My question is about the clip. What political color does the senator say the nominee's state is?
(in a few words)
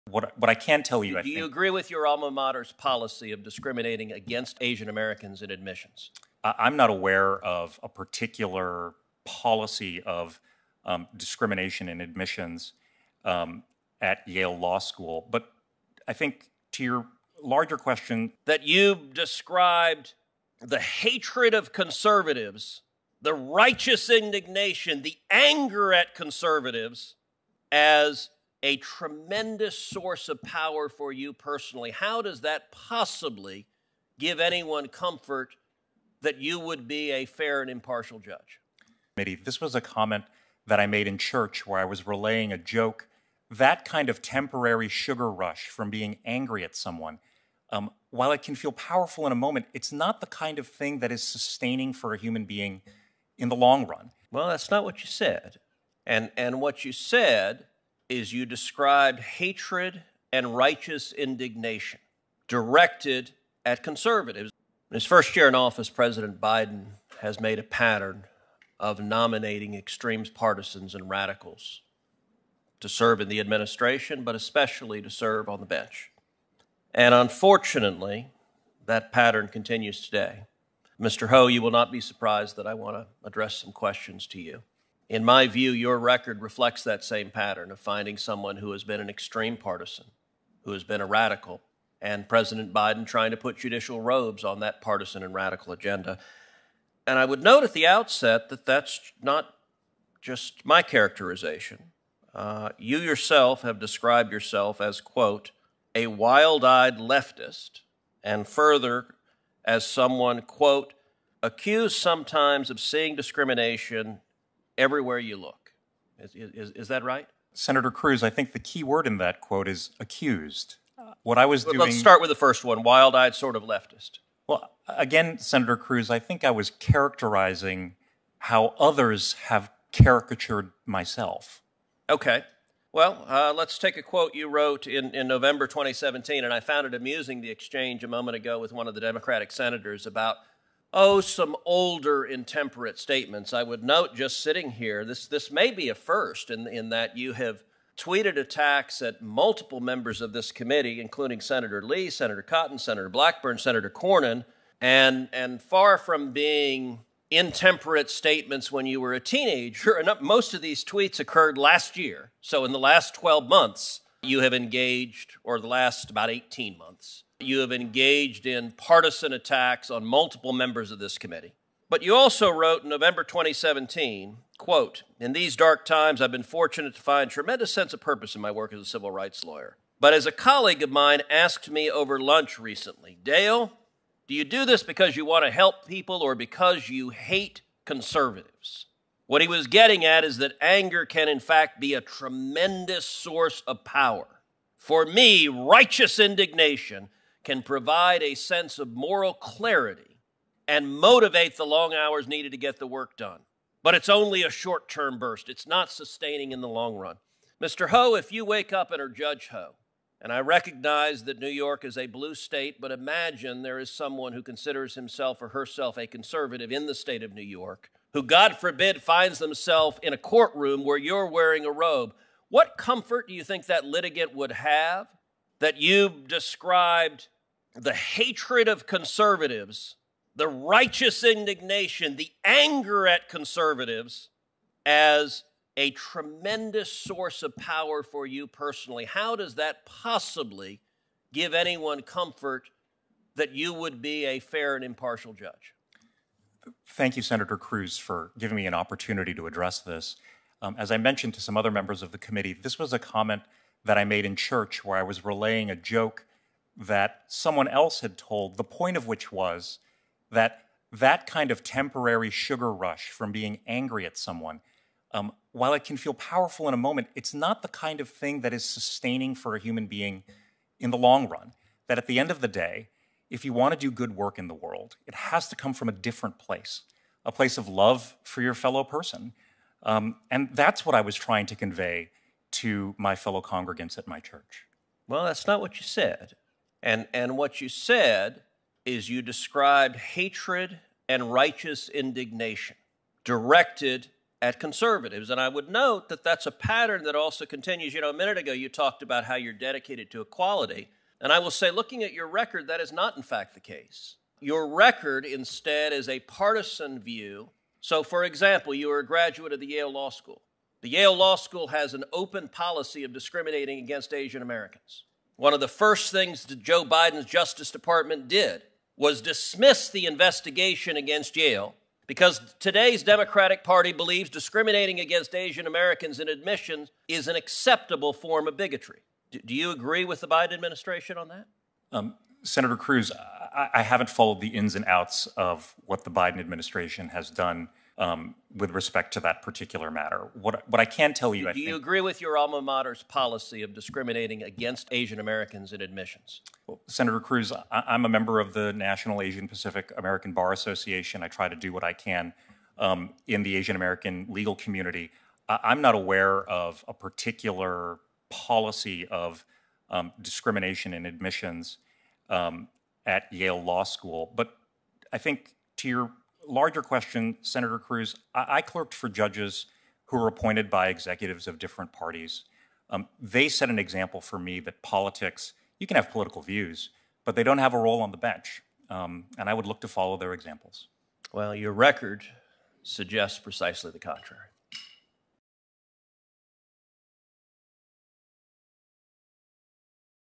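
blue.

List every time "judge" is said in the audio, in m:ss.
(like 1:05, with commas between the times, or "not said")
0:38, 3:29, 4:05, 6:09.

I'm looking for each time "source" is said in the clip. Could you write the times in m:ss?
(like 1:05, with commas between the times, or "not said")
0:29, 3:13, 3:56.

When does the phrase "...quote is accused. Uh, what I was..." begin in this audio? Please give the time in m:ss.
1:59.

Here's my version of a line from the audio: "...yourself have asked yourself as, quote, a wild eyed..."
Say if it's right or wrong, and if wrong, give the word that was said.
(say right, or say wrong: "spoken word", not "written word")
wrong: "described", not "asked".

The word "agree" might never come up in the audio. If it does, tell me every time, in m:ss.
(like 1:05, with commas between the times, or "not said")
0:01, 5:29, 5:41.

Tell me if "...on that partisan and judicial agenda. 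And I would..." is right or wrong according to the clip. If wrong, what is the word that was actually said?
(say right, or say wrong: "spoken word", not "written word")
wrong: "radical", not "judicial".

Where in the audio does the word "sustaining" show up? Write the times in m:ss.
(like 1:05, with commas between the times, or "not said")
0:51, 3:25, 4:28.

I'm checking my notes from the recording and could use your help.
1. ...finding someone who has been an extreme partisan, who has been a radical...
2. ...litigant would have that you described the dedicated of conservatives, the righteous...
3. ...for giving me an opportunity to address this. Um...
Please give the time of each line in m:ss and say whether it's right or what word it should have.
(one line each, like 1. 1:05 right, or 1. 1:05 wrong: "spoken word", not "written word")
1. 1:27 right
2. 3:43 wrong: "hatred", not "dedicated"
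3. 4:07 right.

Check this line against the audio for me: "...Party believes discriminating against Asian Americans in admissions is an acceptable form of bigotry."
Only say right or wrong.
right.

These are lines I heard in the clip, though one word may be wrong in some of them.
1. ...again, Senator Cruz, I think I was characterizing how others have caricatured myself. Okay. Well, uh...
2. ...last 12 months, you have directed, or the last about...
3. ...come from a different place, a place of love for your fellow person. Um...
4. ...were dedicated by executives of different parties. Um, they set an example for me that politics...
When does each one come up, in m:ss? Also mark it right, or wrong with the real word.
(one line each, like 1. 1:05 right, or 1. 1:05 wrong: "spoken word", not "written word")
1. 2:04 right
2. 2:42 wrong: "engaged", not "directed"
3. 4:35 right
4. 6:10 wrong: "appointed", not "dedicated".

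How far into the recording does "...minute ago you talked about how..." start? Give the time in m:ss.
4:58.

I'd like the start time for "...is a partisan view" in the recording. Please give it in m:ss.
5:05.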